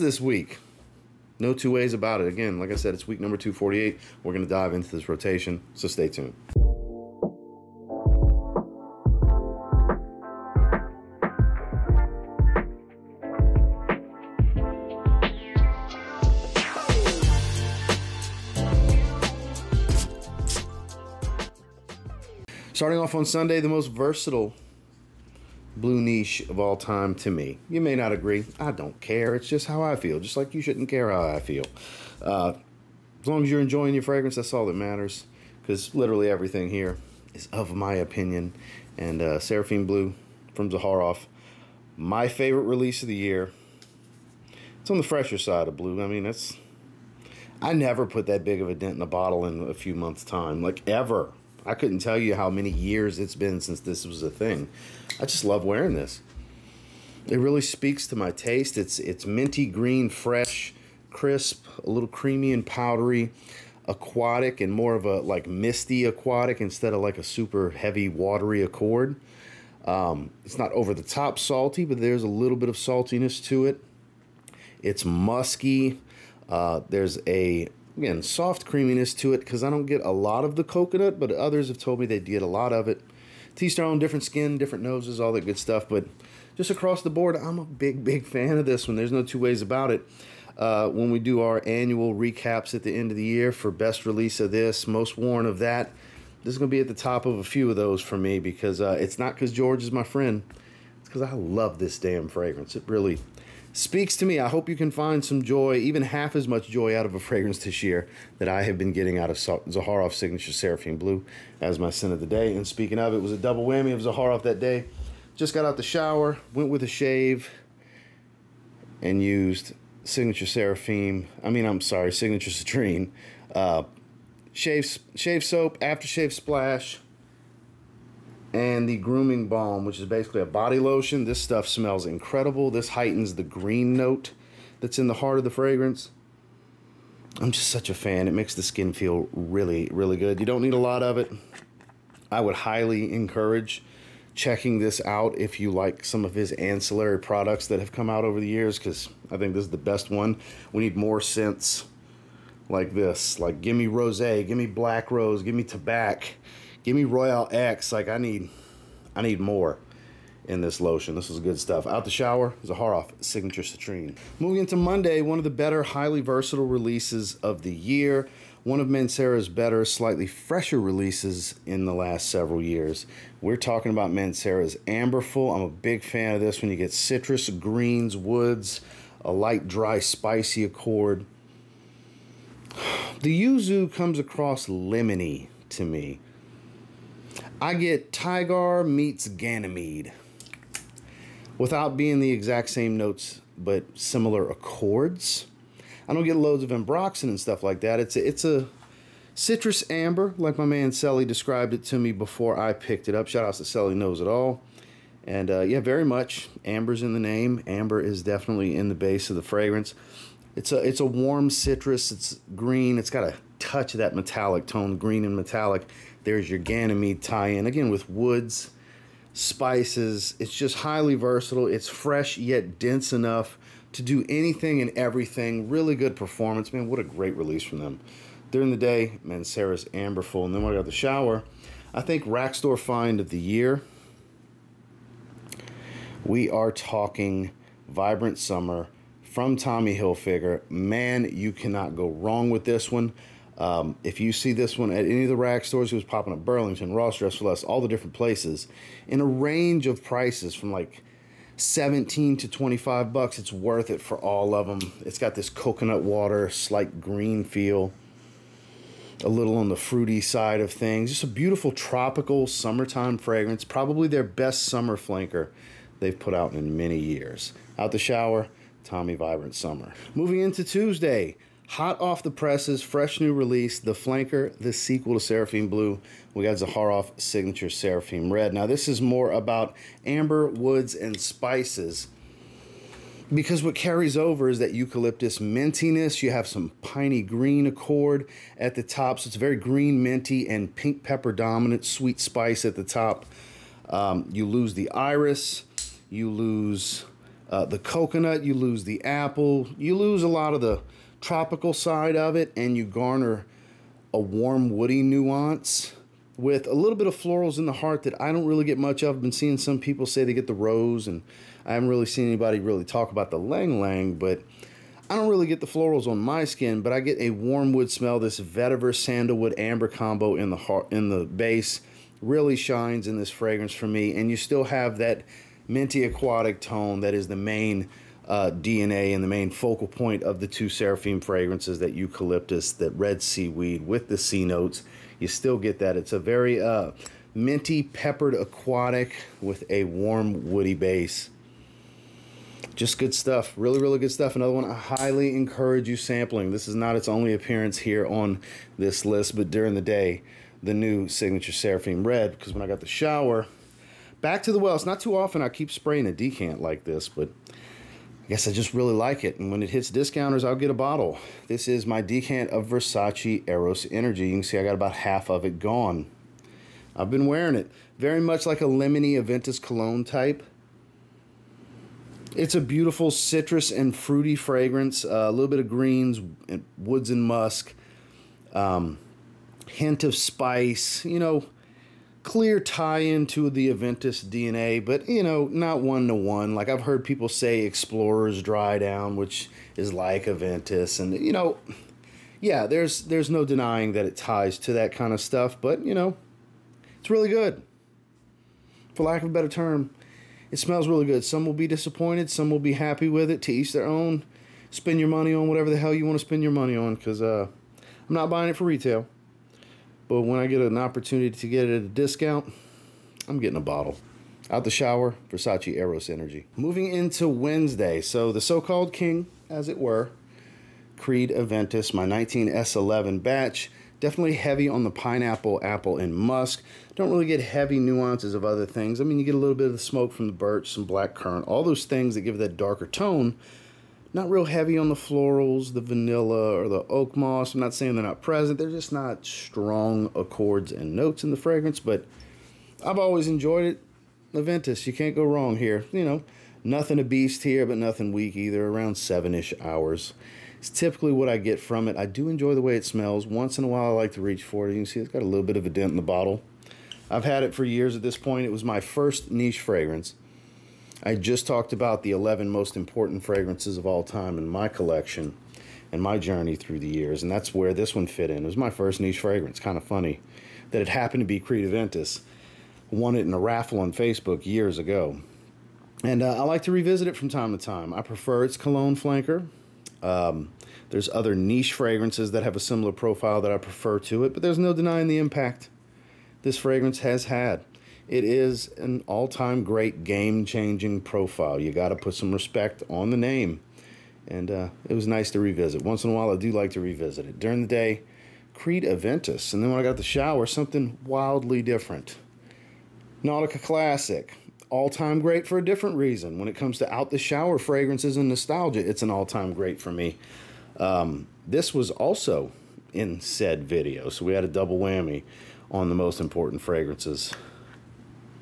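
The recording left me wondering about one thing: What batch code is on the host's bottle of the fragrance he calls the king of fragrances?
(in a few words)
19S11.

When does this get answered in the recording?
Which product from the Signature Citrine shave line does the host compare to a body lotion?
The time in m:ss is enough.
2:08.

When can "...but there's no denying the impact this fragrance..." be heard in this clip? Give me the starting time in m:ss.
8:04.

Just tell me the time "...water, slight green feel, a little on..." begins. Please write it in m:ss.
4:16.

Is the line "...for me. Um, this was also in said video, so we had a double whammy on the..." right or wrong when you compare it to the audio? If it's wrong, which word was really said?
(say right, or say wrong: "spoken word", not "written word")
right.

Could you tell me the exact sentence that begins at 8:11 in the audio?
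You got to put some respect on the name.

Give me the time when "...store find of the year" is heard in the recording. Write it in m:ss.
3:52.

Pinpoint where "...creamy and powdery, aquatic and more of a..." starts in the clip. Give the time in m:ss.
1:02.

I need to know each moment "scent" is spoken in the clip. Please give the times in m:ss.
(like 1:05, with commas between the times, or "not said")
1:51, 2:31.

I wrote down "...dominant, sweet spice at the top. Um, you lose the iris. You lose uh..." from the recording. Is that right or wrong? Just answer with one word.
right.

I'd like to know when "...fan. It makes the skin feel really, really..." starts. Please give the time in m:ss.
2:17.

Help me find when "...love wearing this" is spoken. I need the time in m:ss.
0:55.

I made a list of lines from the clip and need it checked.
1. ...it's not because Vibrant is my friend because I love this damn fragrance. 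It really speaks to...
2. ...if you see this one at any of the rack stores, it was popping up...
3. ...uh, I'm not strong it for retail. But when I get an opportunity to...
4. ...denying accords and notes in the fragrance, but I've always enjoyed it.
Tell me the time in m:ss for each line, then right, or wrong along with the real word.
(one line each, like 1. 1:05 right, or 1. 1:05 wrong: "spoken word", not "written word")
1. 1:38 wrong: "George", not "Vibrant"
2. 4:04 right
3. 6:47 wrong: "buying", not "strong"
4. 7:19 wrong: "strong", not "denying".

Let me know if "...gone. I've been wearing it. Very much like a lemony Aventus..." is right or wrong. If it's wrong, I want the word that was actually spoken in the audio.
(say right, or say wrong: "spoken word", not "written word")
right.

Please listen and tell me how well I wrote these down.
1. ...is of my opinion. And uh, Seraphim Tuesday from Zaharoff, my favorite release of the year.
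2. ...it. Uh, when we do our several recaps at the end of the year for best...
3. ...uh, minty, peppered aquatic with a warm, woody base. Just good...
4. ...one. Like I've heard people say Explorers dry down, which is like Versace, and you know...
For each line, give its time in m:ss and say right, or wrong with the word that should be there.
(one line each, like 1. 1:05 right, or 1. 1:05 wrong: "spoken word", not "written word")
1. 0:37 wrong: "Blue", not "Tuesday"
2. 1:29 wrong: "annual", not "several"
3. 5:36 right
4. 6:26 wrong: "Aventus", not "Versace".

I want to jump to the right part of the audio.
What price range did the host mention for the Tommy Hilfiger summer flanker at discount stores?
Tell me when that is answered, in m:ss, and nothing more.
4:11.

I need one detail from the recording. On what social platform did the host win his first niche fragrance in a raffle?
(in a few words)
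Facebook.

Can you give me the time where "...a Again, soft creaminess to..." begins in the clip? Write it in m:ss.
1:17.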